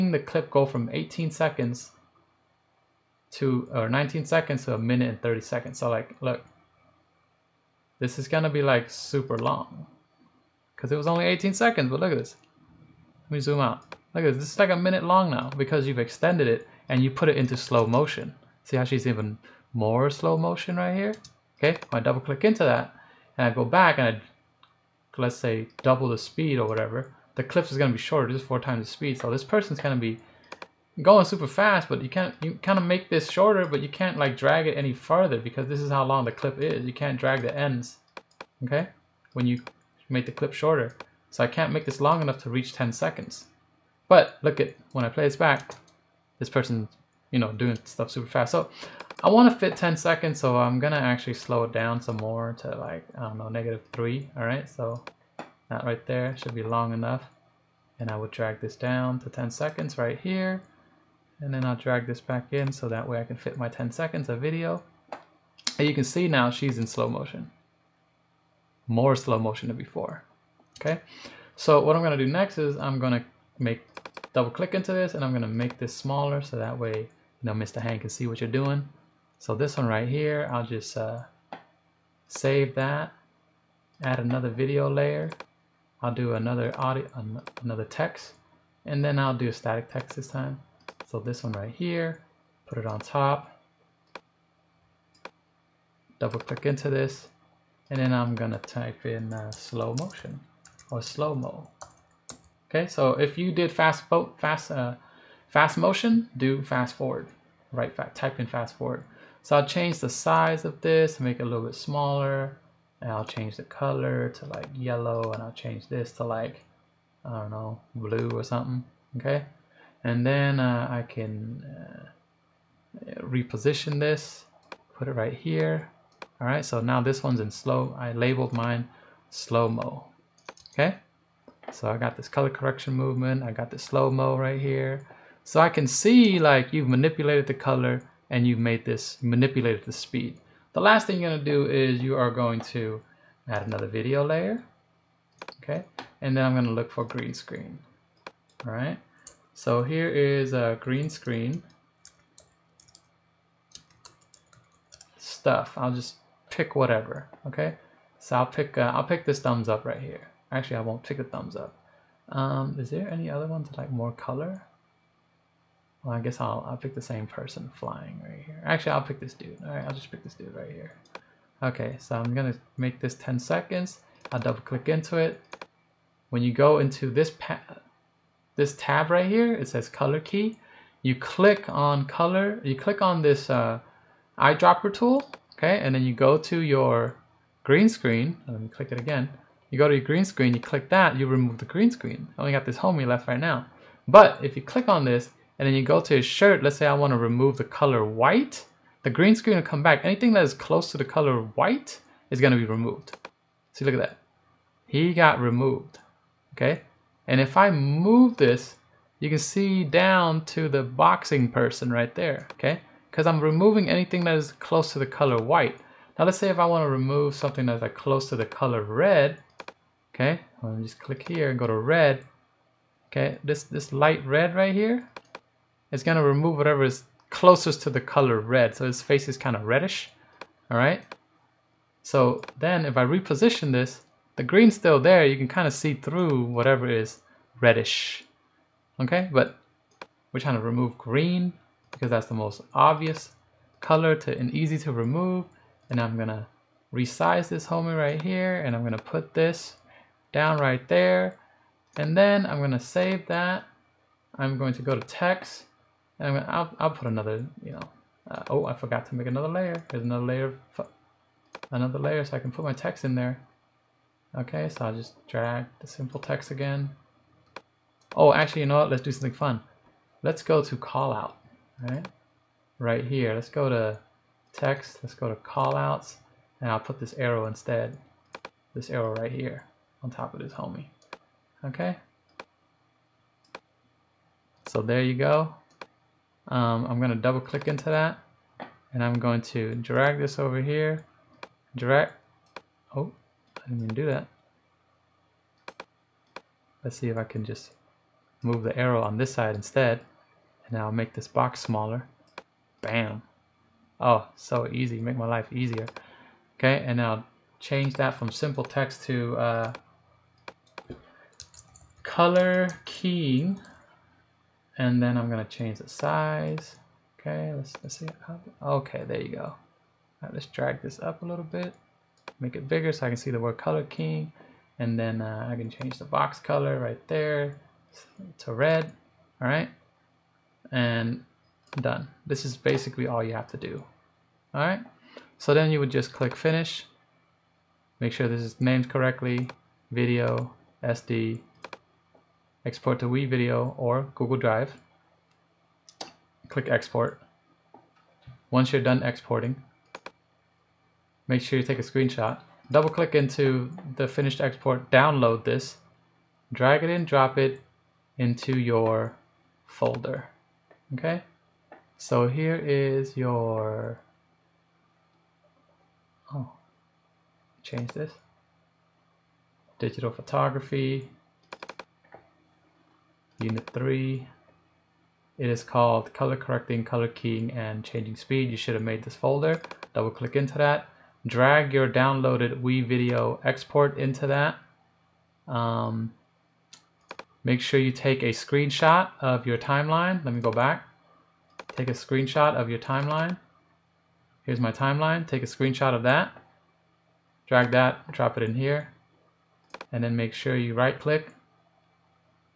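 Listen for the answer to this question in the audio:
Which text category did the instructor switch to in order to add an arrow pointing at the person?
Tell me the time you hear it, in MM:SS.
04:35.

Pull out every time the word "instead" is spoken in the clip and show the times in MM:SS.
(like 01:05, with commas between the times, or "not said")
04:37, 04:59.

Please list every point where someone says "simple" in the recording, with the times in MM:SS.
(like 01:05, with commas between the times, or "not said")
04:25, 05:08.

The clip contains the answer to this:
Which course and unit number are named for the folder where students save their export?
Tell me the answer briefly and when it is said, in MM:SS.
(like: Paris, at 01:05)
digital photography, unit 3, at 06:09.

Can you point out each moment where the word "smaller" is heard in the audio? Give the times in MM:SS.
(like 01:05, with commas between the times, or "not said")
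01:15, 01:51, 05:01.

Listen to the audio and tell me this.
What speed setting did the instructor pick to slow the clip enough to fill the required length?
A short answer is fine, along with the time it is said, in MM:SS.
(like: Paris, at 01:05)
-3, at 00:53.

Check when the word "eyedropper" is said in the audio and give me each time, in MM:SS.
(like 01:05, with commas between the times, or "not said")
03:04.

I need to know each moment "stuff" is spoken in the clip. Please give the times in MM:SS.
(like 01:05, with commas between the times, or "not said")
00:47, 02:35.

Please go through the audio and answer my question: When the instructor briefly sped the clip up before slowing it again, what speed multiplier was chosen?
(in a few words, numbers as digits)
4 times.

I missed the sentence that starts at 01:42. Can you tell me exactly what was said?
Okay, so if you did fast fast uh, fast motion, do fast forward.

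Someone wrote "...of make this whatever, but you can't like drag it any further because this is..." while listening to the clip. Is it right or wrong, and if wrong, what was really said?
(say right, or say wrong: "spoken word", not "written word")
wrong: "shorter", not "whatever".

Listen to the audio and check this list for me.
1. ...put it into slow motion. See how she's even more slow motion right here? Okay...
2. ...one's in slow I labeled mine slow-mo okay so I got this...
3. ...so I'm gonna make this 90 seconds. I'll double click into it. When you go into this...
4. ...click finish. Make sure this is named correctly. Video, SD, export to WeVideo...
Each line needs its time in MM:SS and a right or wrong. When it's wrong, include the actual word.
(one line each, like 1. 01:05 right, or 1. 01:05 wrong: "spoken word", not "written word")
1. 00:17 right
2. 02:07 right
3. 02:51 wrong: "10", not "90"
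4. 05:36 right.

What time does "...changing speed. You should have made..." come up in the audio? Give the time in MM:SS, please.
06:17.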